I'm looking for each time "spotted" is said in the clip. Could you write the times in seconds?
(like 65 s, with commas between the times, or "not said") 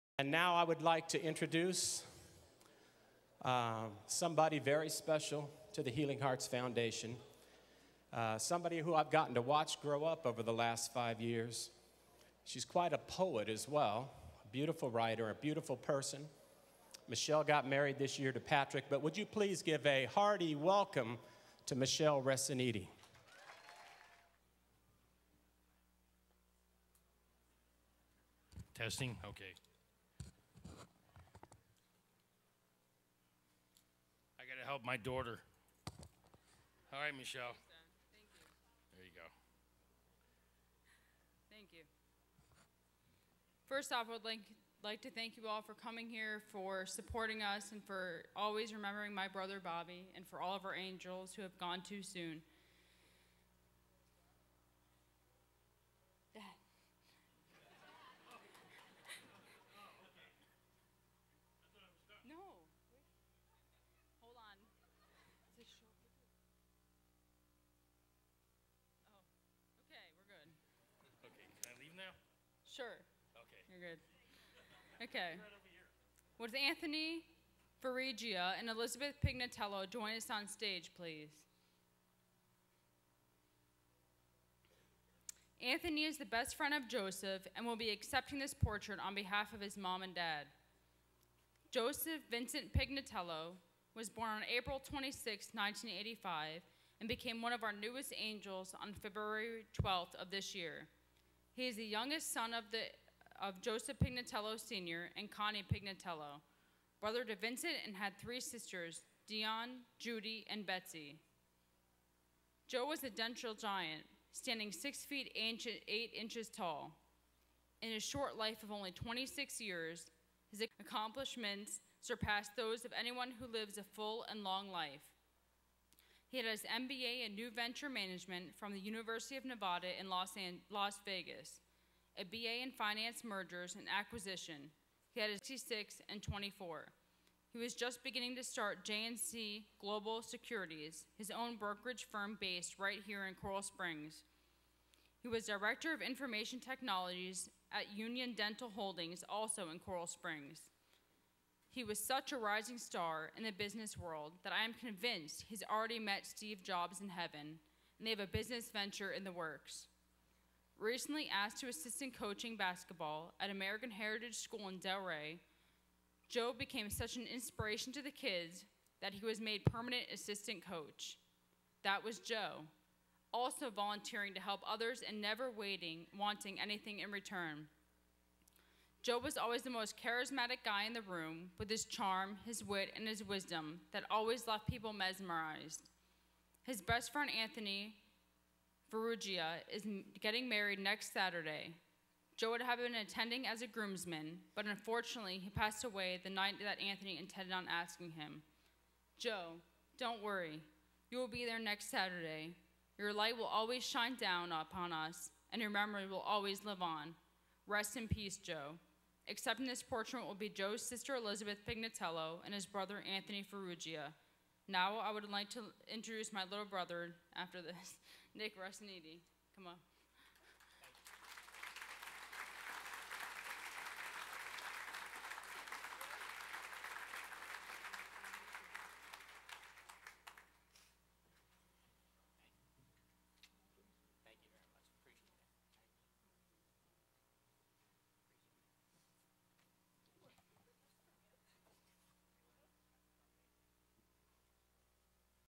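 not said.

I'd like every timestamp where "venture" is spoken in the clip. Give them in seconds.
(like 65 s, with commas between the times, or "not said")
127 s, 158 s.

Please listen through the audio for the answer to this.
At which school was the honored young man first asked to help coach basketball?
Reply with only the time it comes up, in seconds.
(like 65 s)
163 s.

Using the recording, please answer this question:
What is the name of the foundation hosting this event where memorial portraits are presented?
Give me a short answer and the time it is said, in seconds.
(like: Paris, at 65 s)
Healing Hearts Foundation, at 5 s.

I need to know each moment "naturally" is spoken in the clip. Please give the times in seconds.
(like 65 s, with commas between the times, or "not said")
not said.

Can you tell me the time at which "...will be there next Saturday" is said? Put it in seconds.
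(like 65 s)
201 s.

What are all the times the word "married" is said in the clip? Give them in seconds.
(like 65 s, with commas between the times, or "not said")
17 s, 190 s.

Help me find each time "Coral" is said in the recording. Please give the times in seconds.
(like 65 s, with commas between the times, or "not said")
143 s, 149 s.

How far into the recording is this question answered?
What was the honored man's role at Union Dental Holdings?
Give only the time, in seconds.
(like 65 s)
145 s.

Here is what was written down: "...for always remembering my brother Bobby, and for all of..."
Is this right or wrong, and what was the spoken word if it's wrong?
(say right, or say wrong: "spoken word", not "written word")
right.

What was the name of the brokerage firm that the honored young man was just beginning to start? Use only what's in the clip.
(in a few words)
JNC Global Securities.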